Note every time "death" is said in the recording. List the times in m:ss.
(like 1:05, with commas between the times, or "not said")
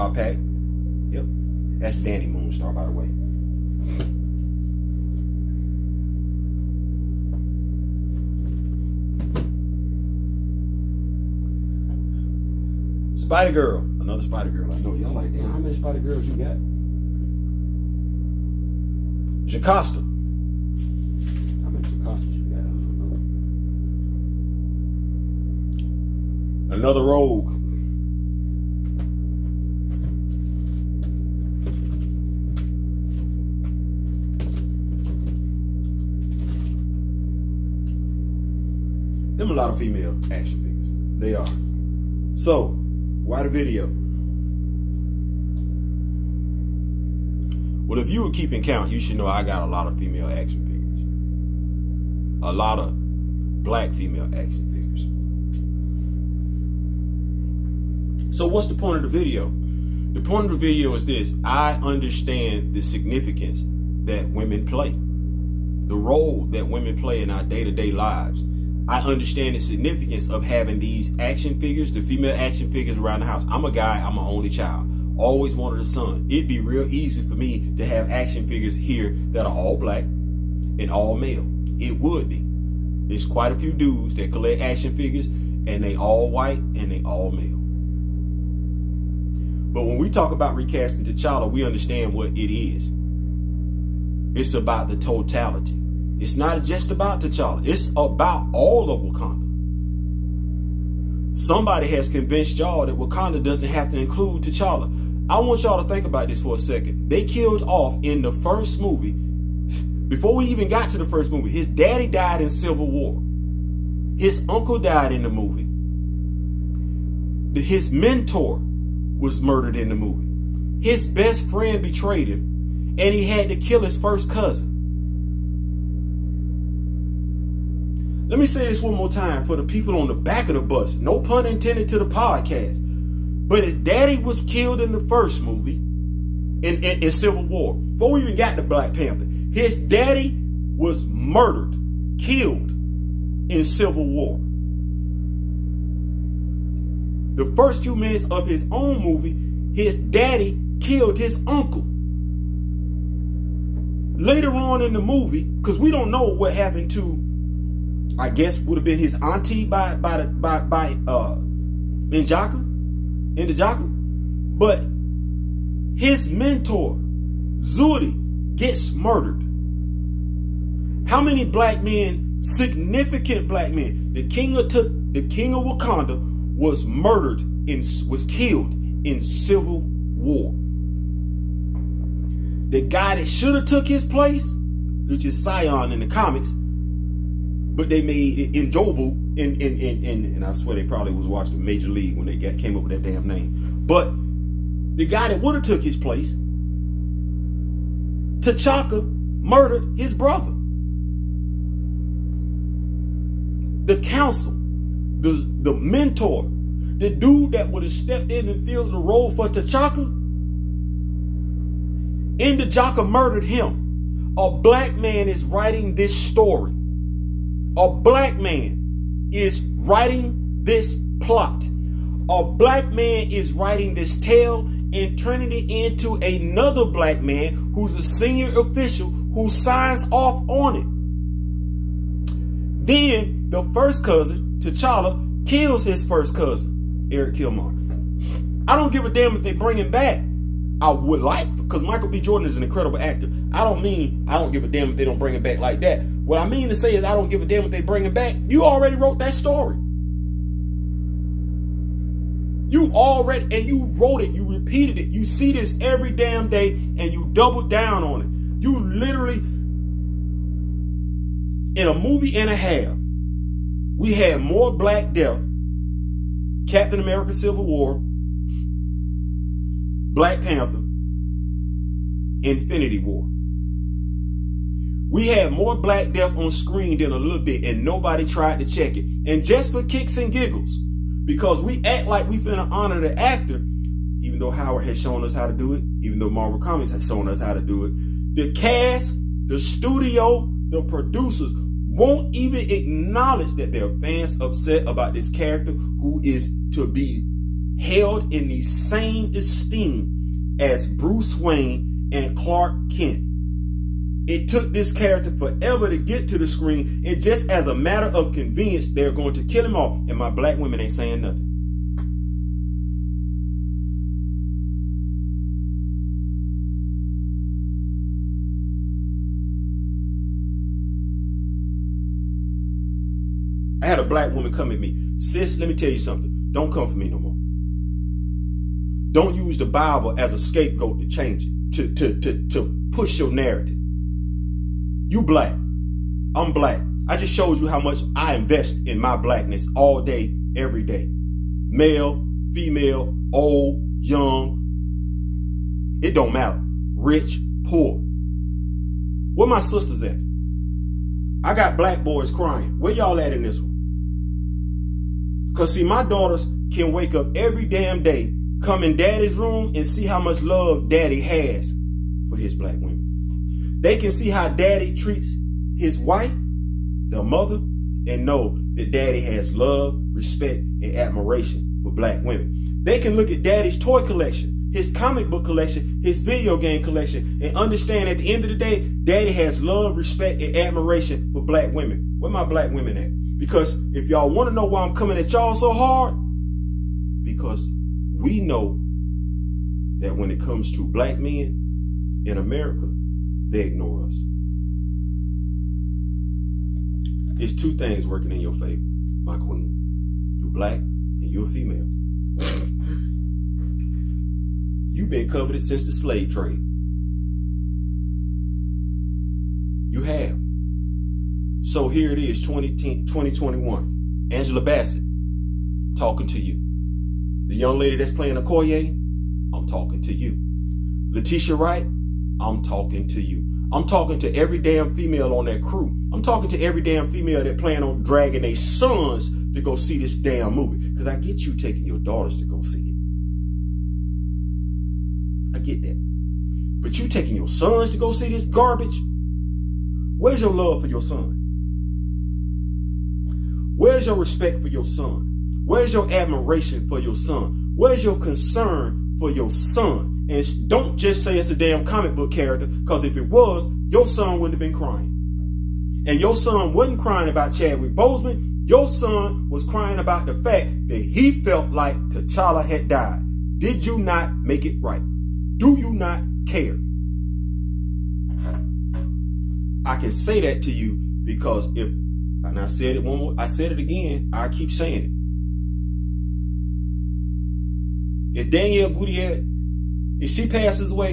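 4:25, 4:36.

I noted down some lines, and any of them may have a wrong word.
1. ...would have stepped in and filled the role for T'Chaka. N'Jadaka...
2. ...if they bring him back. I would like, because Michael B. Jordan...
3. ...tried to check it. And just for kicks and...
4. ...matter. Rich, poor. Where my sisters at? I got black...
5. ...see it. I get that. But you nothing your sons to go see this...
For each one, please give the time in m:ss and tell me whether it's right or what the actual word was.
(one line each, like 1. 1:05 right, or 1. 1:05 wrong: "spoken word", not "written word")
1. 3:27 right
2. 3:59 right
3. 4:38 right
4. 5:46 right
5. 7:12 wrong: "taking", not "nothing".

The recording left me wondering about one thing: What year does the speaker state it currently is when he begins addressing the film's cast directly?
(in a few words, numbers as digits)
2021.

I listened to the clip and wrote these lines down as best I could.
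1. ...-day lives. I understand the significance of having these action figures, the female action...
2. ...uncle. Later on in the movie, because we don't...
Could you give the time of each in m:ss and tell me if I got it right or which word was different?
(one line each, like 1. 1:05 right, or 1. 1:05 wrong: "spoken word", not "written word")
1. 1:07 right
2. 2:31 right.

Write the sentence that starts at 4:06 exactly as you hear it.
What I mean to say is I don't give a damn what they bringing back.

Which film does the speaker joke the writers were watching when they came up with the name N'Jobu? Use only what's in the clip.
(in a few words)
Major League.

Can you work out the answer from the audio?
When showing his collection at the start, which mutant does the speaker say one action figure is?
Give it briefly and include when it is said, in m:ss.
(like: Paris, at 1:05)
Dani Moonstar, at 0:01.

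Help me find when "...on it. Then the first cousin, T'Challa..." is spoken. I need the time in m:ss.
3:50.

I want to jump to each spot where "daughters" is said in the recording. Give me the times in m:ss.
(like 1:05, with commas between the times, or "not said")
5:56, 7:11.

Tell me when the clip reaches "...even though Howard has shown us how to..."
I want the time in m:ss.
4:44.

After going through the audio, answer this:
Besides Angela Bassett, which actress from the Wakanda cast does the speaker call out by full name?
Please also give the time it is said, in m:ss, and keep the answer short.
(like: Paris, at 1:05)
Letitia Wright, at 7:01.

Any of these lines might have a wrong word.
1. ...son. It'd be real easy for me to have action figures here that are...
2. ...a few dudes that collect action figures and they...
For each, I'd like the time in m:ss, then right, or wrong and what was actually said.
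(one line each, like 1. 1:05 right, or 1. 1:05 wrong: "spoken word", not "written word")
1. 1:15 right
2. 1:23 right.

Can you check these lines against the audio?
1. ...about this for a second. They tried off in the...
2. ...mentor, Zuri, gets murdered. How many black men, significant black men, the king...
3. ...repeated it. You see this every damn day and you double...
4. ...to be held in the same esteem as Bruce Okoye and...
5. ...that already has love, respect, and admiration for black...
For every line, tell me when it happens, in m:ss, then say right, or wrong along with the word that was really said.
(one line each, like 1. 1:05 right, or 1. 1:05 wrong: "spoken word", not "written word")
1. 1:46 wrong: "killed", not "tried"
2. 2:46 right
3. 4:14 right
4. 4:56 wrong: "Wayne", not "Okoye"
5. 6:08 wrong: "daddy", not "already".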